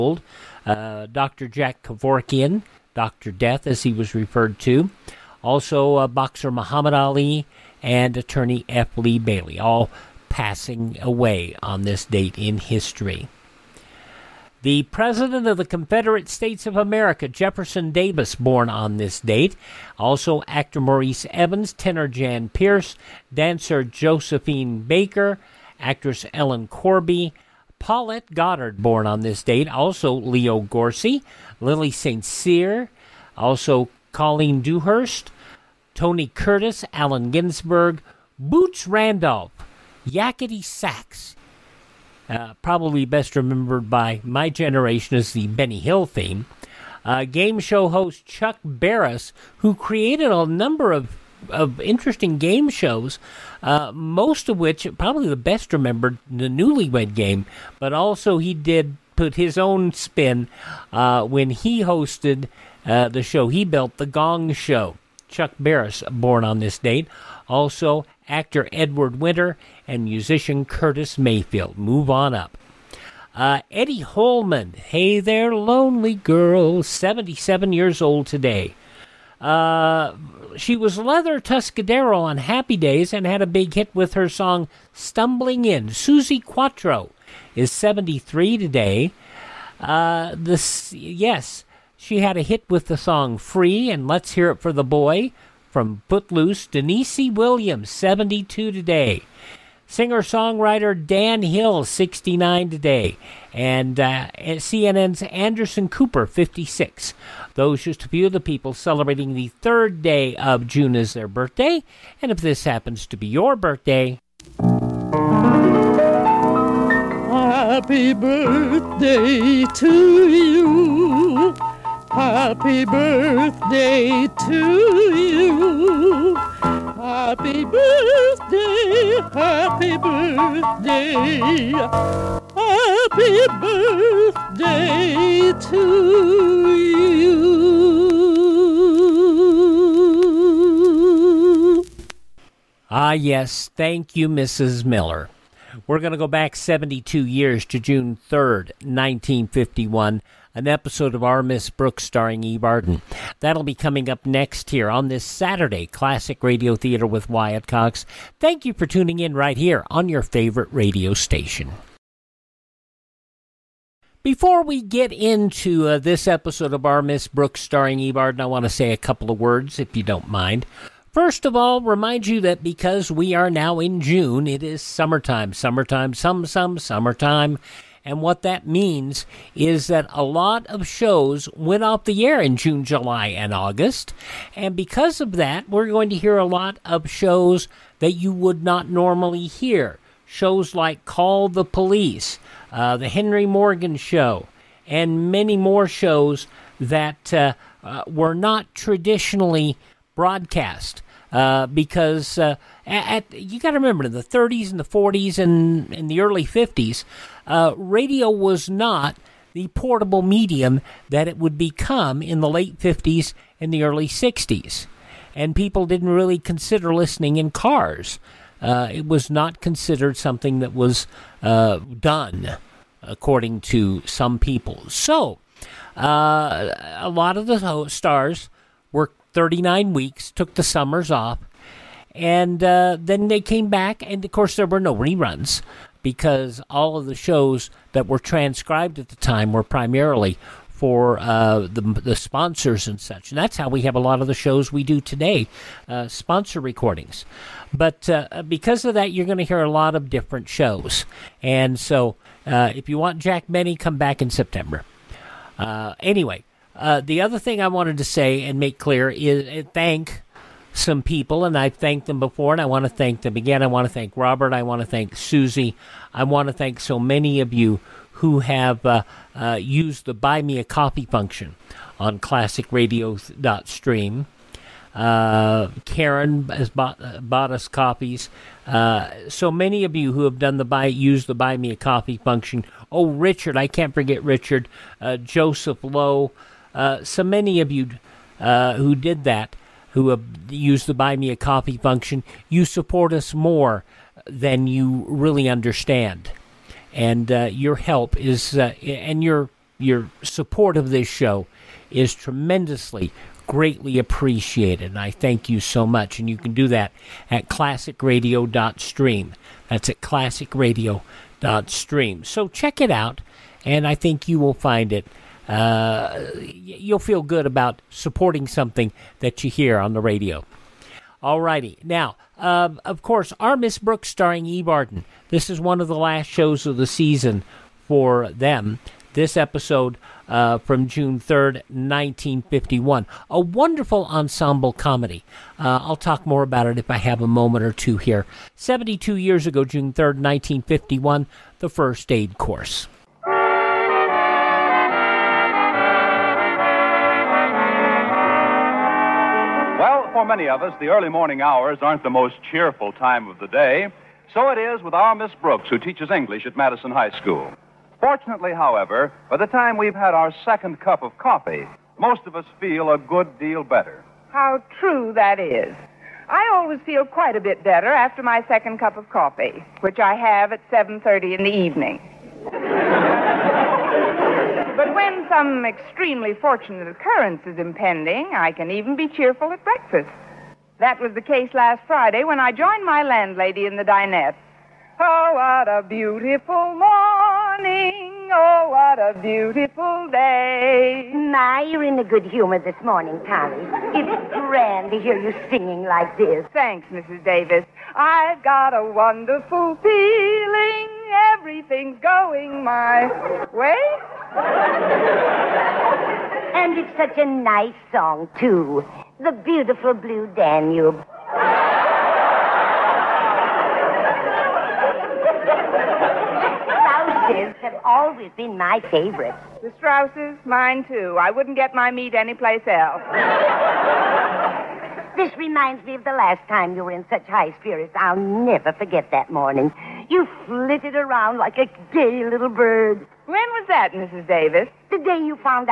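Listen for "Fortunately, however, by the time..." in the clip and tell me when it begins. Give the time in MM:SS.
05:58.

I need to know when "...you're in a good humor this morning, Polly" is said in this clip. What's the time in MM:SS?
06:31.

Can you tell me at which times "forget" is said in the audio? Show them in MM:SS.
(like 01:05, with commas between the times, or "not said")
04:43, 07:08.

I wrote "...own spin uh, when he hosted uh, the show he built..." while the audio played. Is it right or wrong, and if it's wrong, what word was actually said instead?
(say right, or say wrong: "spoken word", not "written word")
right.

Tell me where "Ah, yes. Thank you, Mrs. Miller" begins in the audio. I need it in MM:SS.
02:22.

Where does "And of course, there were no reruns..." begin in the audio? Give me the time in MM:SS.
03:54.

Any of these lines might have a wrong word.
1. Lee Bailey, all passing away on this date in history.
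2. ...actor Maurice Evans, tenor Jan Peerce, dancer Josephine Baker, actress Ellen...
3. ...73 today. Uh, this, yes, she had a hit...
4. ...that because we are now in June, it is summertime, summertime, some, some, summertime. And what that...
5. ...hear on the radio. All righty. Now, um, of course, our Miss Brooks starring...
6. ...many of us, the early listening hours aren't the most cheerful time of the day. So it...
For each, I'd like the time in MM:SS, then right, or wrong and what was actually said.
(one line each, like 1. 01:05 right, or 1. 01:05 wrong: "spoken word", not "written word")
1. 00:08 right
2. 00:20 right
3. 01:27 right
4. 02:52 right
5. 05:19 right
6. 05:50 wrong: "morning", not "listening".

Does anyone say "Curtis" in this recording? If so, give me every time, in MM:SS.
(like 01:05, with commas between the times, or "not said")
00:36, 01:10.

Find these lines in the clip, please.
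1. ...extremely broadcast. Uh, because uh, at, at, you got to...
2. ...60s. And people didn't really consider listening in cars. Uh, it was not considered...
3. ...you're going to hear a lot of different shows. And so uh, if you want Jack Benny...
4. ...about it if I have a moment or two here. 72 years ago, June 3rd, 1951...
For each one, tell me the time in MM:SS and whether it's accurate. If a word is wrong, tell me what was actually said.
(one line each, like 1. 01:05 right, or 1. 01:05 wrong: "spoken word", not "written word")
1. 03:18 wrong: "traditionally", not "extremely"
2. 03:34 right
3. 04:09 right
4. 05:36 right.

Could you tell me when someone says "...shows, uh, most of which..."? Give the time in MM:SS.
00:52.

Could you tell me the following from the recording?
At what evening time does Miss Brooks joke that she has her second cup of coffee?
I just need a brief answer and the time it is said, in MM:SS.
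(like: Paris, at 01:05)
7:30, at 06:10.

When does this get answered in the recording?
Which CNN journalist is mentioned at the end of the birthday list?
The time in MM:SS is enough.
01:45.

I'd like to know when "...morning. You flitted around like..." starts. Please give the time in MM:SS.
07:09.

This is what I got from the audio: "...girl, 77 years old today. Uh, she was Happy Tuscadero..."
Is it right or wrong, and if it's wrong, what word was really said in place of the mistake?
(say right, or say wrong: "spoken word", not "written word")
wrong: "Leather", not "Happy".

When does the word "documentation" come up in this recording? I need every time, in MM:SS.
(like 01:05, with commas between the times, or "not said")
not said.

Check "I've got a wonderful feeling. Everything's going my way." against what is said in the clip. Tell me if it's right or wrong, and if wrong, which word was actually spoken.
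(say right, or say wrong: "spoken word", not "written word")
right.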